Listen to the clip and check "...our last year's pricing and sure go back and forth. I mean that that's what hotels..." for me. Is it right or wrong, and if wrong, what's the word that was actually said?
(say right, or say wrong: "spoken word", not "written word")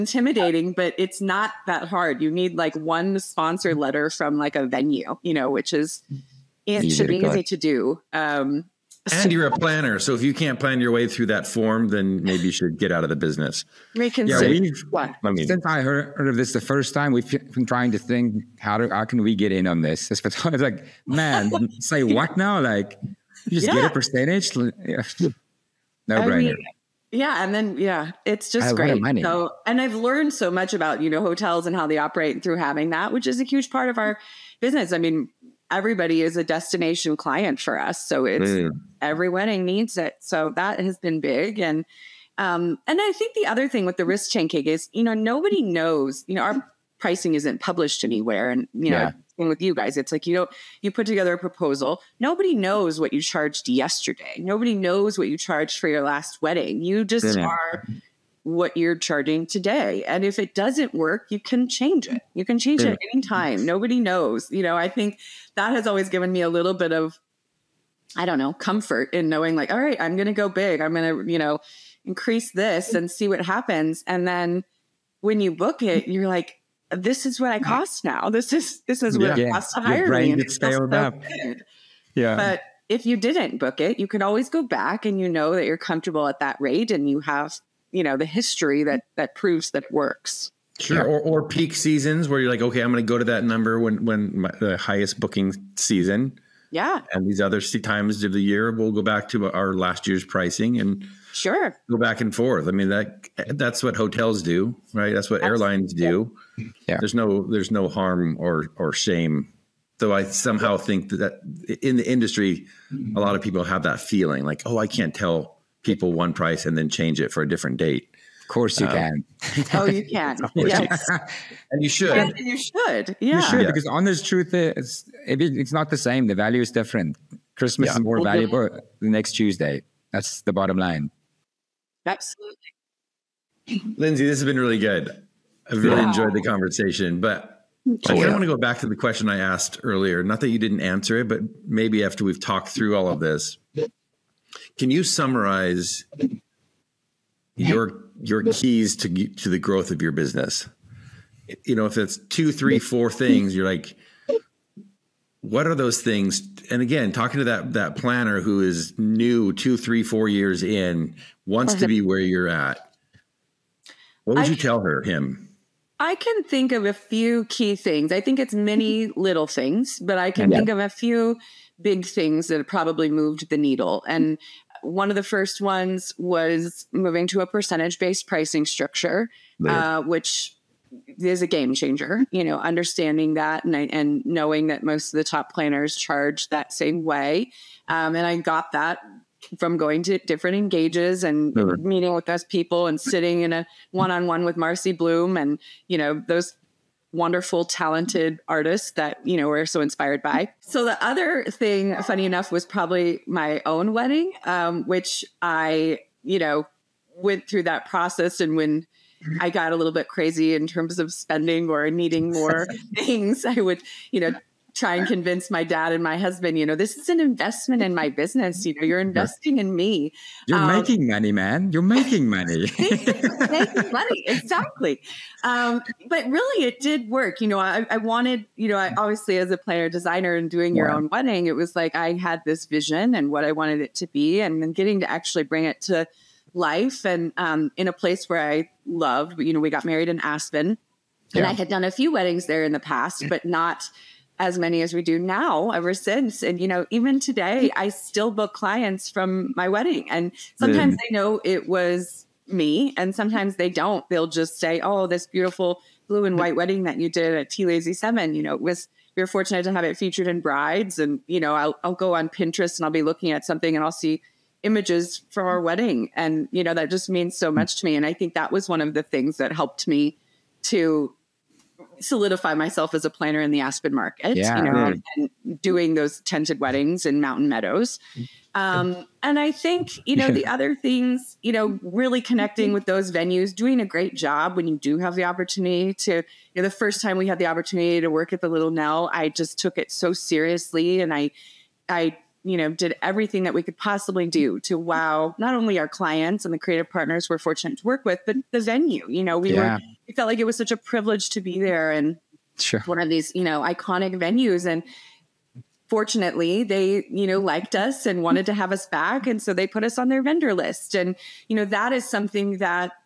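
right.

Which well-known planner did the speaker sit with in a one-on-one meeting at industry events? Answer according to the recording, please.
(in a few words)
Marcy Blum.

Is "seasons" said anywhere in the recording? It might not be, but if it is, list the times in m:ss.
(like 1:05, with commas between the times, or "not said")
1:31, 1:35.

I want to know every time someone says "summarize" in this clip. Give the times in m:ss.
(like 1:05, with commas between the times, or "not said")
2:25.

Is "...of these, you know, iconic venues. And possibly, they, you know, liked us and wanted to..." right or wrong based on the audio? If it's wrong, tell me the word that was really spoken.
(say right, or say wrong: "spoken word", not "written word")
wrong: "fortunately", not "possibly".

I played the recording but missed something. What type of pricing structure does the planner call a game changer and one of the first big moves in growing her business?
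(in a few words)
percentage based pricing.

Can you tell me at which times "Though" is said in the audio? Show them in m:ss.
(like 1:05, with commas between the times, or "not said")
1:49.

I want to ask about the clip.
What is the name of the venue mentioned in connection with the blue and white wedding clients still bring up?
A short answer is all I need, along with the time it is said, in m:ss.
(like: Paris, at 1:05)
T Lazy Seven, at 4:17.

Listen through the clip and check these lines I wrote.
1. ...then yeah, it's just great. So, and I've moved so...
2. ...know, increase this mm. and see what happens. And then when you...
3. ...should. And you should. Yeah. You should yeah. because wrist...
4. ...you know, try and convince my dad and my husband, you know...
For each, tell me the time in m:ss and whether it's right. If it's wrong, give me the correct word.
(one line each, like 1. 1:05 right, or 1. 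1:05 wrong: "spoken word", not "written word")
1. 0:27 wrong: "learned", not "moved"
2. 1:11 right
3. 2:01 wrong: "honest", not "wrist"
4. 3:34 right.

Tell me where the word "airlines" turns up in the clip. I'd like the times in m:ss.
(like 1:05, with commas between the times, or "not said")
1:45.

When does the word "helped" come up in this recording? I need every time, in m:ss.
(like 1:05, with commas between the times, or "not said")
4:29.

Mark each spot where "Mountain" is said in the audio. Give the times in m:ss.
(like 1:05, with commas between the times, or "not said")
4:37.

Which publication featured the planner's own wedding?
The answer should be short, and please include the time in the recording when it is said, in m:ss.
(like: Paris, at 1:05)
Brides, at 4:20.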